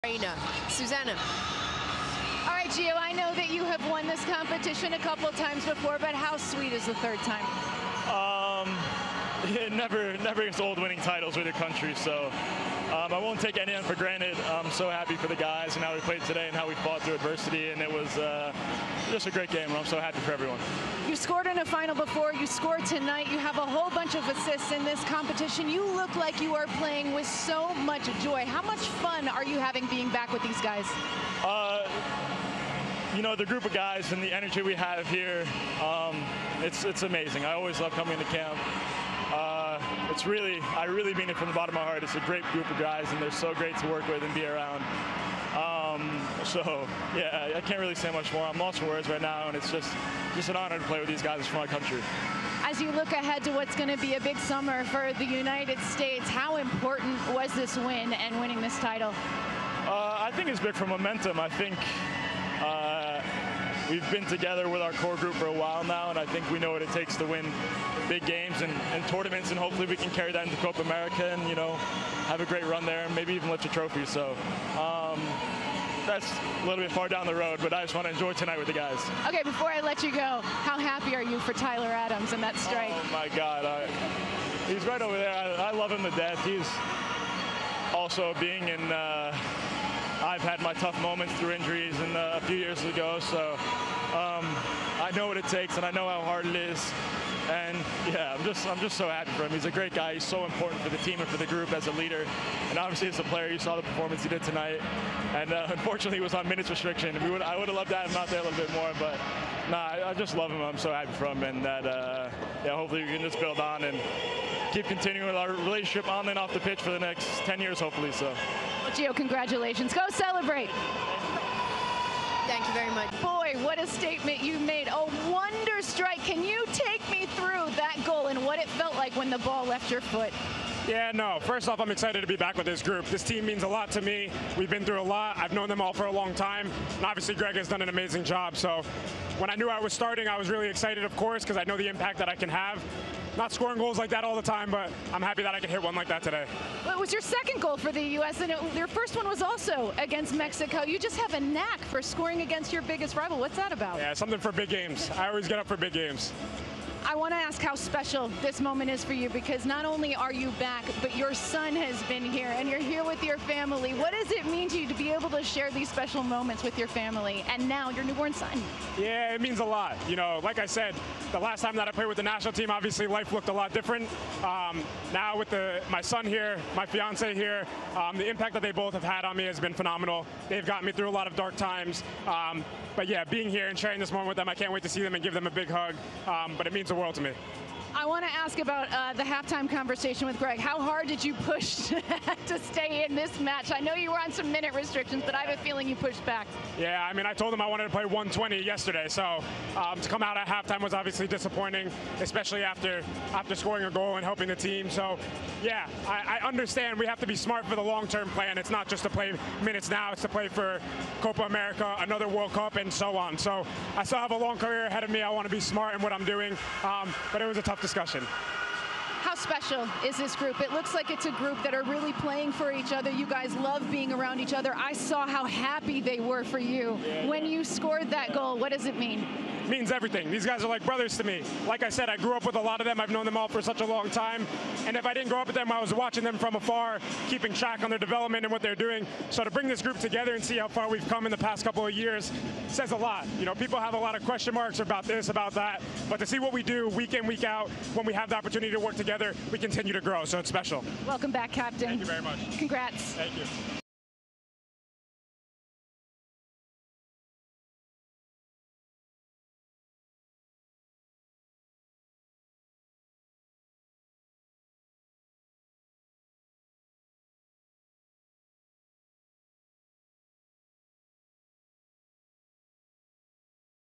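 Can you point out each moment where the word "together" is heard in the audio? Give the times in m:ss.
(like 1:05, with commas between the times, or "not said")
1:04, 3:59, 4:08.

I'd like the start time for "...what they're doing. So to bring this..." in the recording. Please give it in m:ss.
3:58.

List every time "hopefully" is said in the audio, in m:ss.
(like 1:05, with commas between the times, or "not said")
1:09, 1:52, 1:57.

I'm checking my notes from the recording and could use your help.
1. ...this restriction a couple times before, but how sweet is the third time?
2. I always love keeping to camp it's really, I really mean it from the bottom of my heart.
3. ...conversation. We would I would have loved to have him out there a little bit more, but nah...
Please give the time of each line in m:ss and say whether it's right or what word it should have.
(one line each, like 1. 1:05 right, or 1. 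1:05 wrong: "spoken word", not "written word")
1. 0:04 wrong: "competition", not "restriction"
2. 0:37 wrong: "coming", not "keeping"
3. 1:46 wrong: "restriction", not "conversation".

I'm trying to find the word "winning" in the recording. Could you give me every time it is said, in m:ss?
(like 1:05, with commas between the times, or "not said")
0:10, 0:58.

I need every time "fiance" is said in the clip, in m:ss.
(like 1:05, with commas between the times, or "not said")
2:56.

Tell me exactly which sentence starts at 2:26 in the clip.
it was your second goal for the U.S., and it, your first one was also against Mexico.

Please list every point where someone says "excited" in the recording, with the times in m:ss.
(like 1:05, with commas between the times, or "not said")
2:11, 2:20.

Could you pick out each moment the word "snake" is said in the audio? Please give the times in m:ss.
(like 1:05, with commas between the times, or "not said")
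not said.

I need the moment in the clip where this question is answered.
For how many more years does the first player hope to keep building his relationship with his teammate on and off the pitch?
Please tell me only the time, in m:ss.
1:57.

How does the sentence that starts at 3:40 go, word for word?
It looks like it's a group that are really playing for each other.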